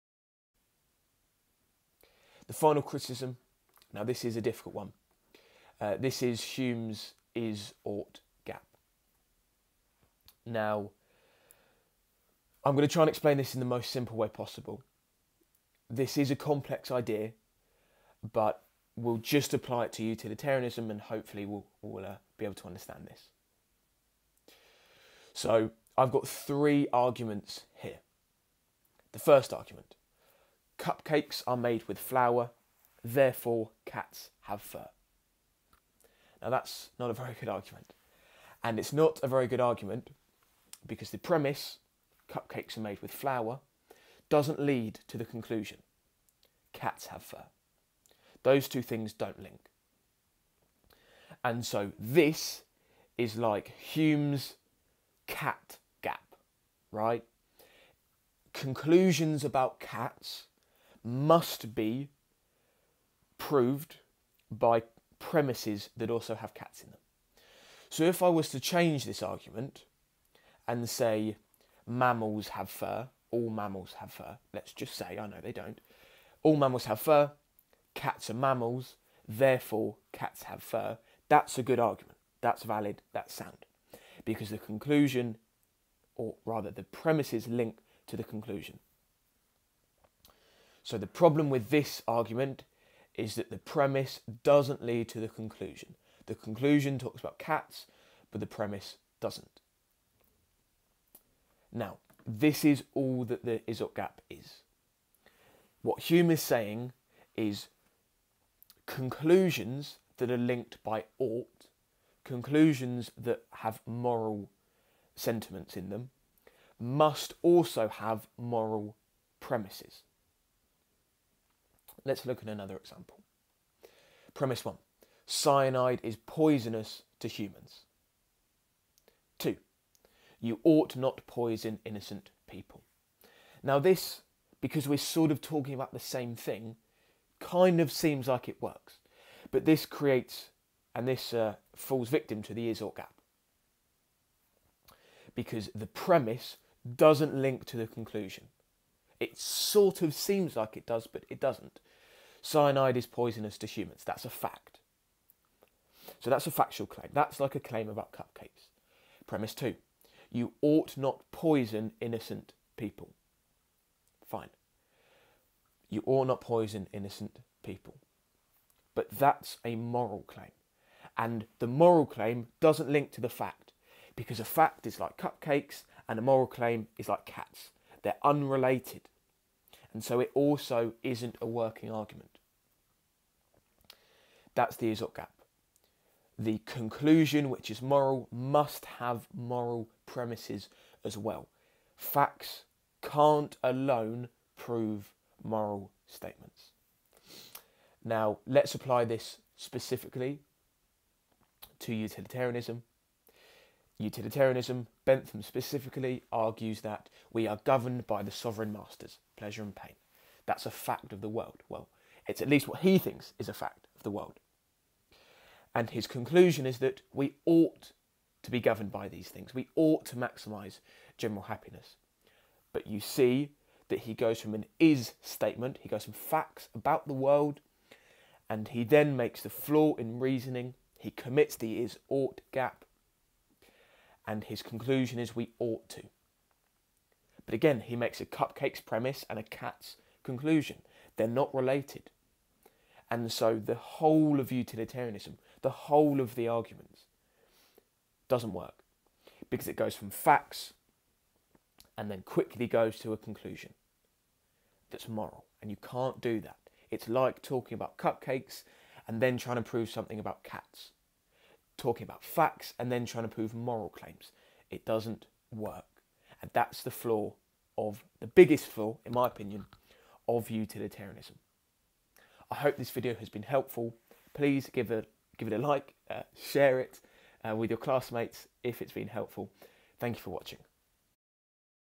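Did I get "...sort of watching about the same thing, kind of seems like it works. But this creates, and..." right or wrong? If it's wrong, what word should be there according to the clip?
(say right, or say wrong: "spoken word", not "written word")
wrong: "talking", not "watching".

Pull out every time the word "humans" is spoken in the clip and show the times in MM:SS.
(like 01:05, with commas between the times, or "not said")
02:07, 02:33.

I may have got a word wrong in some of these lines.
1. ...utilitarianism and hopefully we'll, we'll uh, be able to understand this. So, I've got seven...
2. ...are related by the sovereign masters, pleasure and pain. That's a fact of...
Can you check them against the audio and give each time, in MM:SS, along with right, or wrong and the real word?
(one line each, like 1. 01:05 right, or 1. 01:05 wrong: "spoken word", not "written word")
1. 00:20 wrong: "three", not "seven"
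2. 03:27 wrong: "governed", not "related".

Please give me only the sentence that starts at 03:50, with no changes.
He commits the is ought gap and his conclusion is we ought to.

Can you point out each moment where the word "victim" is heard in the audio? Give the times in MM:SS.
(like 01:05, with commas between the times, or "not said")
02:22.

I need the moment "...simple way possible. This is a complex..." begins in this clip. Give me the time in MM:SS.
00:13.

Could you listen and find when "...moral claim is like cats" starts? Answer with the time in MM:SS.
02:56.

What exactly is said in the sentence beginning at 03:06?
The conclusion, which is moral, must have moral premises as well.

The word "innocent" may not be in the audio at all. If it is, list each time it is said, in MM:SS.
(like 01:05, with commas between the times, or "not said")
02:11, 02:42, 02:46.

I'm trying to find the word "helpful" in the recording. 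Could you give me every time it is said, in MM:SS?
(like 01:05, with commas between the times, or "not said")
04:33, 04:39.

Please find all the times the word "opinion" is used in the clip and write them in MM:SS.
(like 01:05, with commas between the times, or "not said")
04:29.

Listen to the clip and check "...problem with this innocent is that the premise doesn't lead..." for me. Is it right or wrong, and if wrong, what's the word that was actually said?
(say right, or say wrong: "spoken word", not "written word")
wrong: "argument", not "innocent".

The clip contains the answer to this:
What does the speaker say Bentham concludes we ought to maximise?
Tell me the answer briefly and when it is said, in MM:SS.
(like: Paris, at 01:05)
General happiness, at 03:41.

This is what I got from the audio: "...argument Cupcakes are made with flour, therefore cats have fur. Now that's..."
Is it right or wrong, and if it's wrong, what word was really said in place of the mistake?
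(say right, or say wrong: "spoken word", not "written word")
right.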